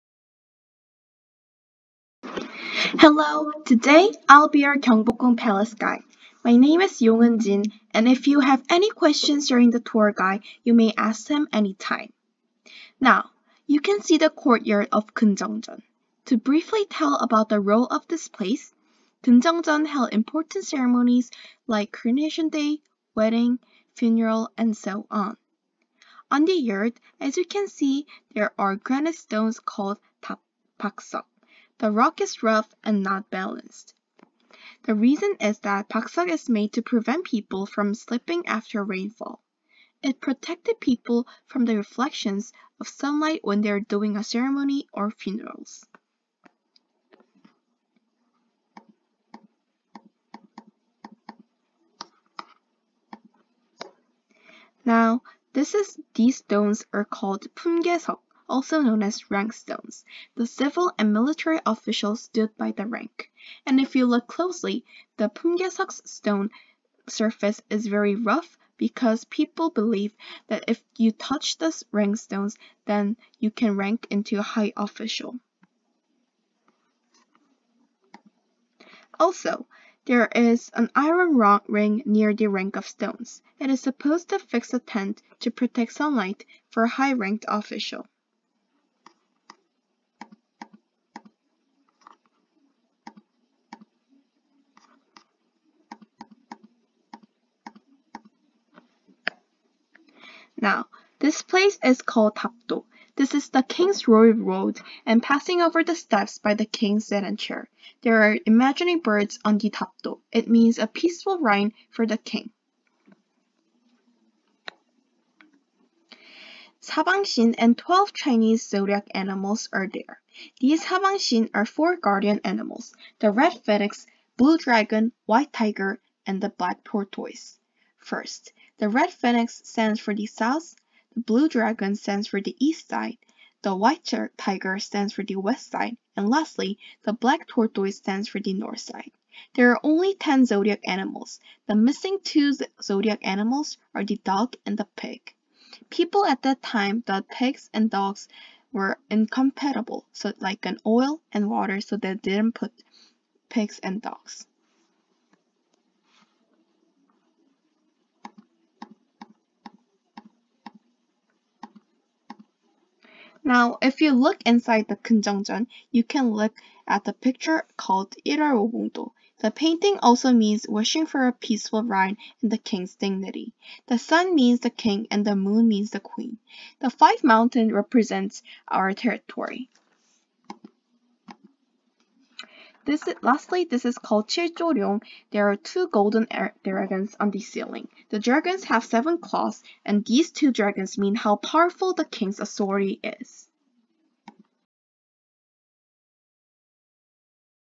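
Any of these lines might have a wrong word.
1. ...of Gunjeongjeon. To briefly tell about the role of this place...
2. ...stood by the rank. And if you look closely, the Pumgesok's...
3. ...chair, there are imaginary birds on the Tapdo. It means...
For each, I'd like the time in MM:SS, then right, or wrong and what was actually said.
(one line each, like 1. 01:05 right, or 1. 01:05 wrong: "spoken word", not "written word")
1. 00:14 right
2. 01:02 right
3. 01:47 right.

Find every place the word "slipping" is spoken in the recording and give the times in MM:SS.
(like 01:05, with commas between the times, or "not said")
00:37.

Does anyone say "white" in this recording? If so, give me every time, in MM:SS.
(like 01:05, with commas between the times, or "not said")
02:05, 02:13.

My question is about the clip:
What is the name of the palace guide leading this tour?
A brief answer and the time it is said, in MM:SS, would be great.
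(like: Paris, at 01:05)
Yongun Jin, at 00:07.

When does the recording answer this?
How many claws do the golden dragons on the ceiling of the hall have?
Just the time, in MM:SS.
03:08.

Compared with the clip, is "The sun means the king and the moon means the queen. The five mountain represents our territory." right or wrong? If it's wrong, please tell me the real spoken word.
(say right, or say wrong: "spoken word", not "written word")
right.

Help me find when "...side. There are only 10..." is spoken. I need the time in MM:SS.
02:18.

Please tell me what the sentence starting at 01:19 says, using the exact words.
Also, there is an iron ring near the rank of stones.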